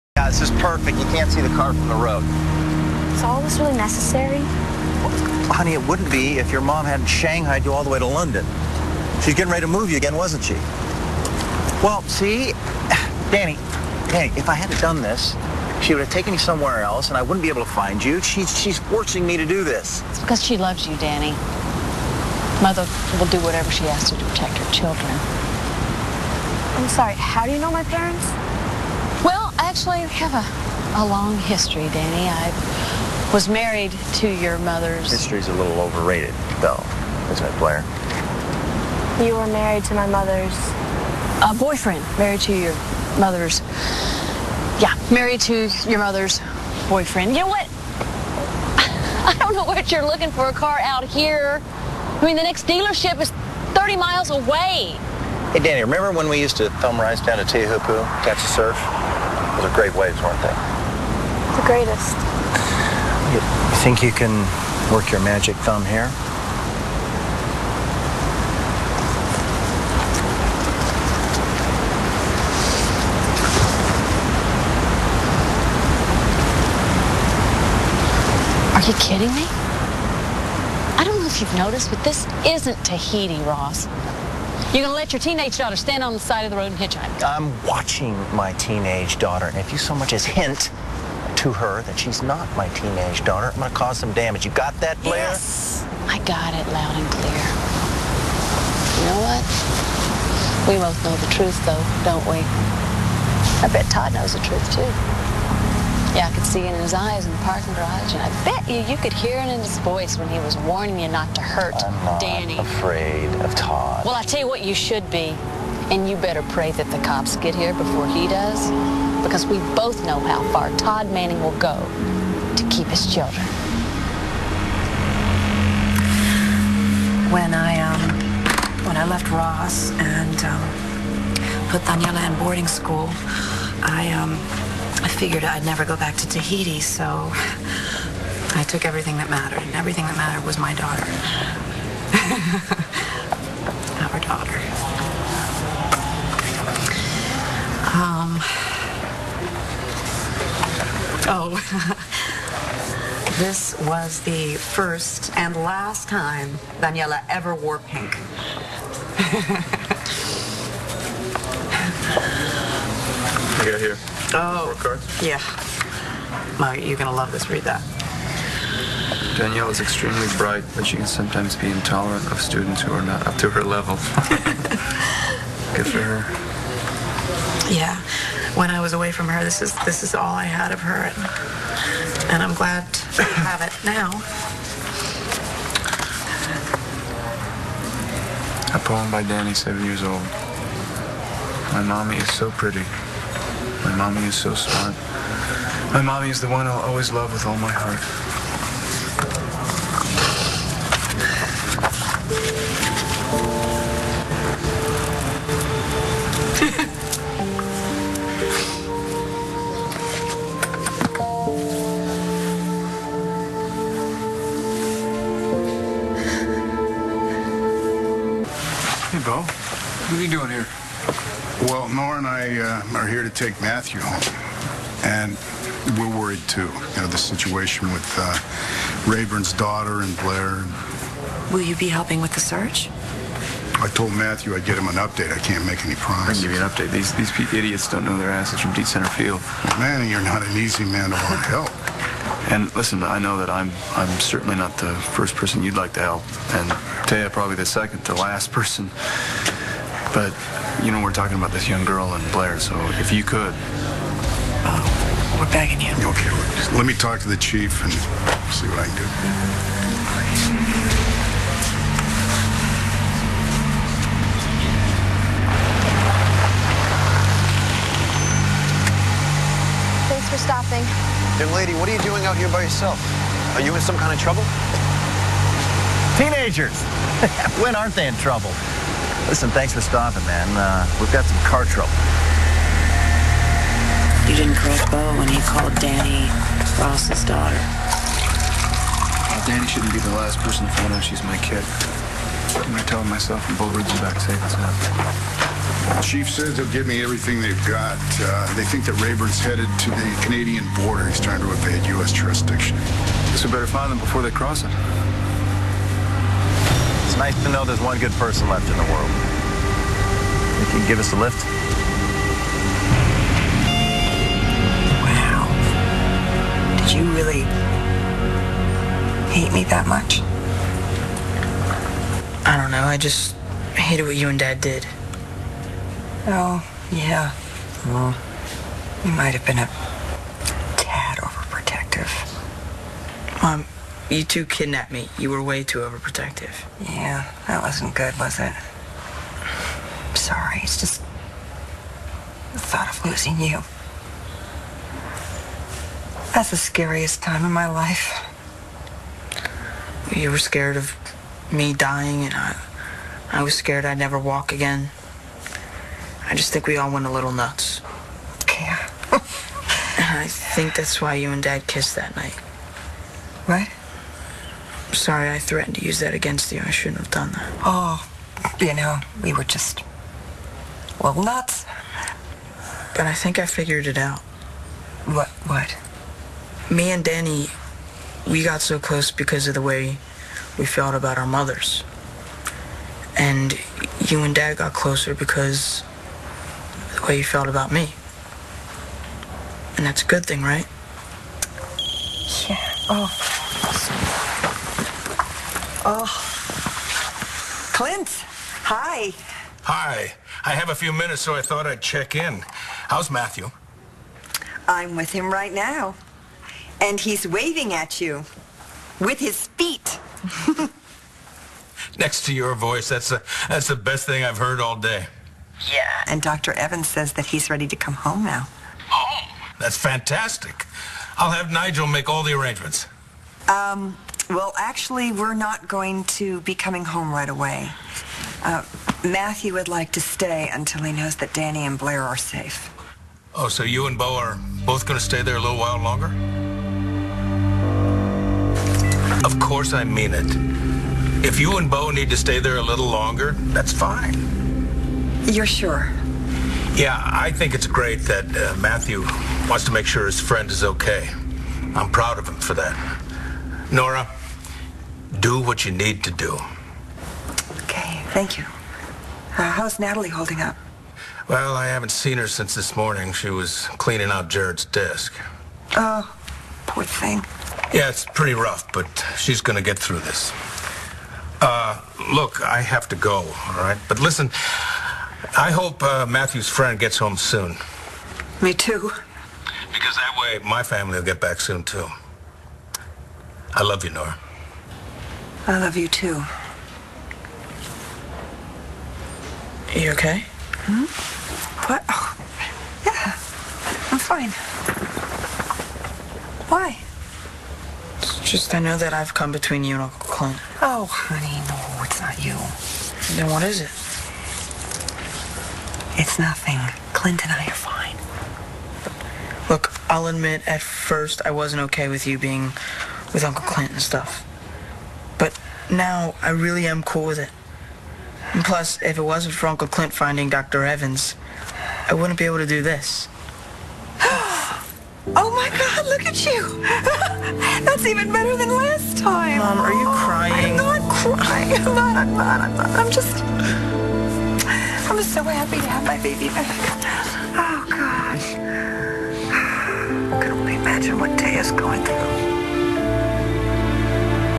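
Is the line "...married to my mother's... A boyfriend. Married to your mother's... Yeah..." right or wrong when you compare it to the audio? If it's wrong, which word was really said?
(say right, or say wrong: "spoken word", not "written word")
right.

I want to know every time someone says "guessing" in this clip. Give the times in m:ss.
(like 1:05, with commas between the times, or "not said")
not said.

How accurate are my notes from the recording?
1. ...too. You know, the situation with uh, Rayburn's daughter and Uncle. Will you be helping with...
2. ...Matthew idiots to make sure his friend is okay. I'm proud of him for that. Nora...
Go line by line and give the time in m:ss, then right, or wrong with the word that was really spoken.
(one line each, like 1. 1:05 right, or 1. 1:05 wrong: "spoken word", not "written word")
1. 3:46 wrong: "Blair", not "Uncle"
2. 7:28 wrong: "wants", not "idiots".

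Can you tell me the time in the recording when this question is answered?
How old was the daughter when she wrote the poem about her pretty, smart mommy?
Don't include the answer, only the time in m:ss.
3:09.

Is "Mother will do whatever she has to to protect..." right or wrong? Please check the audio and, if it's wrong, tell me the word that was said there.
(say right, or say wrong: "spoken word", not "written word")
right.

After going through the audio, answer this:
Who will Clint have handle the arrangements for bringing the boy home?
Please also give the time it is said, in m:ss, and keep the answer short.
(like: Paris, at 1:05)
Nigel, at 7:01.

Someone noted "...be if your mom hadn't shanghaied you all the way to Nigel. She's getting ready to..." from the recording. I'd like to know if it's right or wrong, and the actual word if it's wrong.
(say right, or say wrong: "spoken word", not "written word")
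wrong: "London", not "Nigel".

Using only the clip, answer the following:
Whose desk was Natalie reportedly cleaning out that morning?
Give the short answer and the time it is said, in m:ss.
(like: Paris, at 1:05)
Jared's, at 7:44.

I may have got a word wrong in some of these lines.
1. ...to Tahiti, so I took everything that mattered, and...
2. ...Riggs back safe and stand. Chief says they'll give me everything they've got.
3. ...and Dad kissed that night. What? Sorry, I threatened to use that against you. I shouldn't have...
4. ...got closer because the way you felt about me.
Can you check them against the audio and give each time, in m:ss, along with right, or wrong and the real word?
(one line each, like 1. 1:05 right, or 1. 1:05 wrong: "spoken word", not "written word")
1. 2:16 right
2. 4:53 wrong: "sound", not "stand"
3. 6:01 right
4. 6:24 right.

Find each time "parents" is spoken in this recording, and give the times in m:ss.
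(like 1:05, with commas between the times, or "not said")
0:27.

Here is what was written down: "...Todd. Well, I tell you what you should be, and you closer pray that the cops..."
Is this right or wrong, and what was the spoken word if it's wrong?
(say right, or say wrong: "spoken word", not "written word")
wrong: "better", not "closer".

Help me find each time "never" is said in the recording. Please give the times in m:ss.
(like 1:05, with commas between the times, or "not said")
2:15, 5:53.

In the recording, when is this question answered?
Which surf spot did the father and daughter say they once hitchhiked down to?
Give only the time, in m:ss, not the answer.
0:57.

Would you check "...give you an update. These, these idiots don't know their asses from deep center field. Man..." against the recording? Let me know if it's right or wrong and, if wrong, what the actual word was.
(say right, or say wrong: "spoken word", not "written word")
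right.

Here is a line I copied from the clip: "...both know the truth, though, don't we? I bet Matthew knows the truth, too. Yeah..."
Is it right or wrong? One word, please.
wrong.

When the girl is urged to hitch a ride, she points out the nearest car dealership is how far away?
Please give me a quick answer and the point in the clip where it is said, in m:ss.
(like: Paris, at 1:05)
30 miles, at 0:53.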